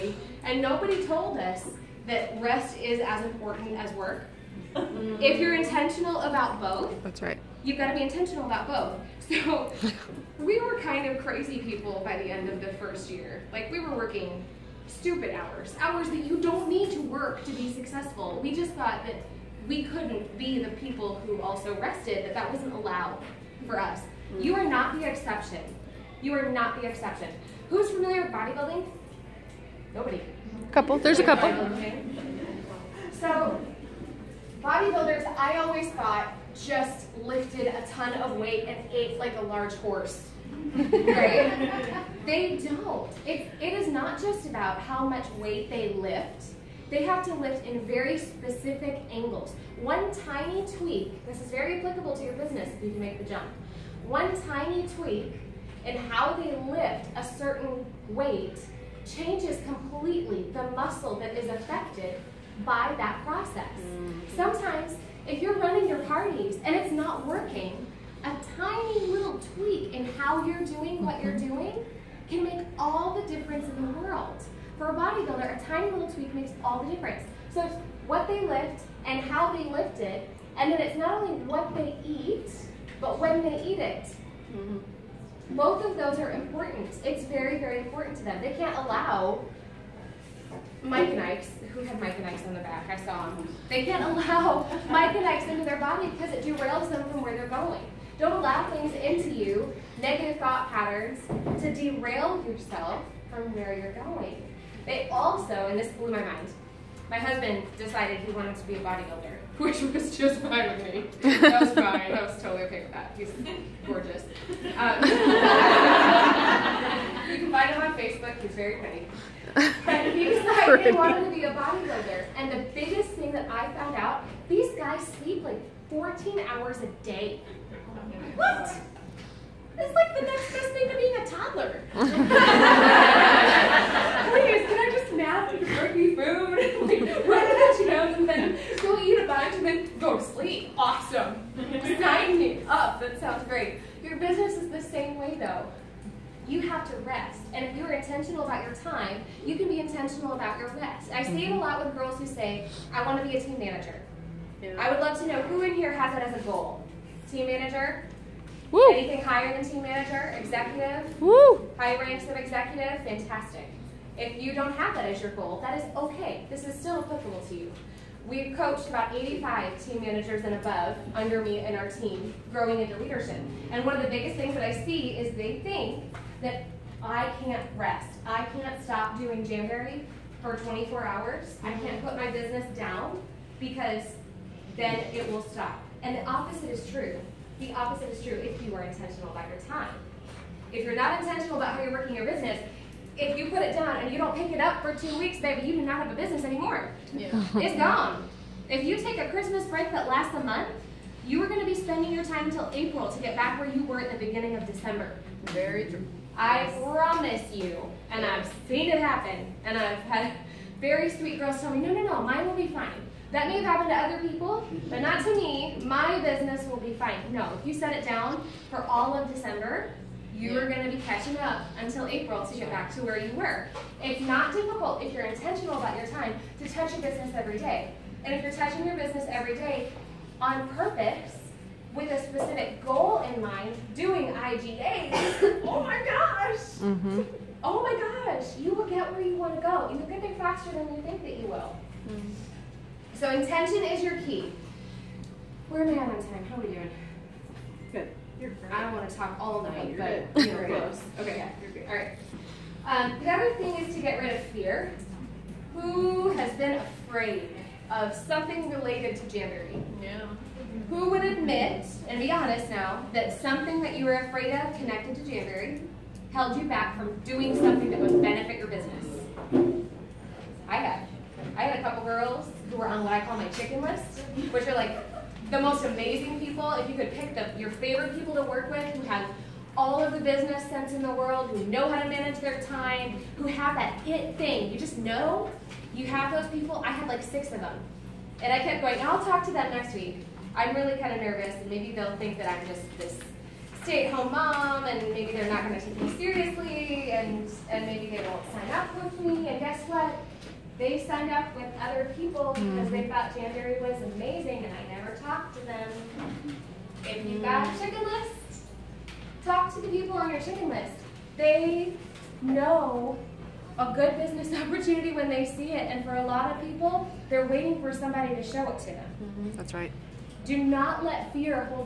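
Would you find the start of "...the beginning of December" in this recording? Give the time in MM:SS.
03:24.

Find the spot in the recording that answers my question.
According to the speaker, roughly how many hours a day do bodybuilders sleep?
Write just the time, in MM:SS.
02:05.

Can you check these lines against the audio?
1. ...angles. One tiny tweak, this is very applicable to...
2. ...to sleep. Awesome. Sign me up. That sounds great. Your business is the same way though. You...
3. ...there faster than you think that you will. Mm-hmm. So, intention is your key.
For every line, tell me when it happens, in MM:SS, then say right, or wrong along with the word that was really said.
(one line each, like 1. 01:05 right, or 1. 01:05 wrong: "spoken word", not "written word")
1. 00:49 right
2. 02:20 right
3. 04:00 right.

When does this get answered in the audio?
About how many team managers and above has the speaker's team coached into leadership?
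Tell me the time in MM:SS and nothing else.
02:49.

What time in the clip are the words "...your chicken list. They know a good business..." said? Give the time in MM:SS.
05:10.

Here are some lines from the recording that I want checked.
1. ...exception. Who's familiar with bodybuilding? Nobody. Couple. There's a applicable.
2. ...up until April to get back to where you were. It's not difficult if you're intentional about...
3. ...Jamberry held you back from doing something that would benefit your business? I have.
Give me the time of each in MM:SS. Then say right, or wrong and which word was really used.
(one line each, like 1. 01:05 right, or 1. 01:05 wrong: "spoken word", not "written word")
1. 00:26 wrong: "couple", not "applicable"
2. 03:41 right
3. 04:25 right.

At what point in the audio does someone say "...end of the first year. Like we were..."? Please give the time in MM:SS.
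00:12.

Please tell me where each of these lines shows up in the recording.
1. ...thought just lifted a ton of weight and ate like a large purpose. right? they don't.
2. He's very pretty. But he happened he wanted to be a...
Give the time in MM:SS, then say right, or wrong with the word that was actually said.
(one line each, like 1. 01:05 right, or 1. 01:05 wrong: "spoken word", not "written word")
1. 00:35 wrong: "horse", not "purpose"
2. 01:58 wrong: "decided", not "happened".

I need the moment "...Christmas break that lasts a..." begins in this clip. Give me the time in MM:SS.
03:19.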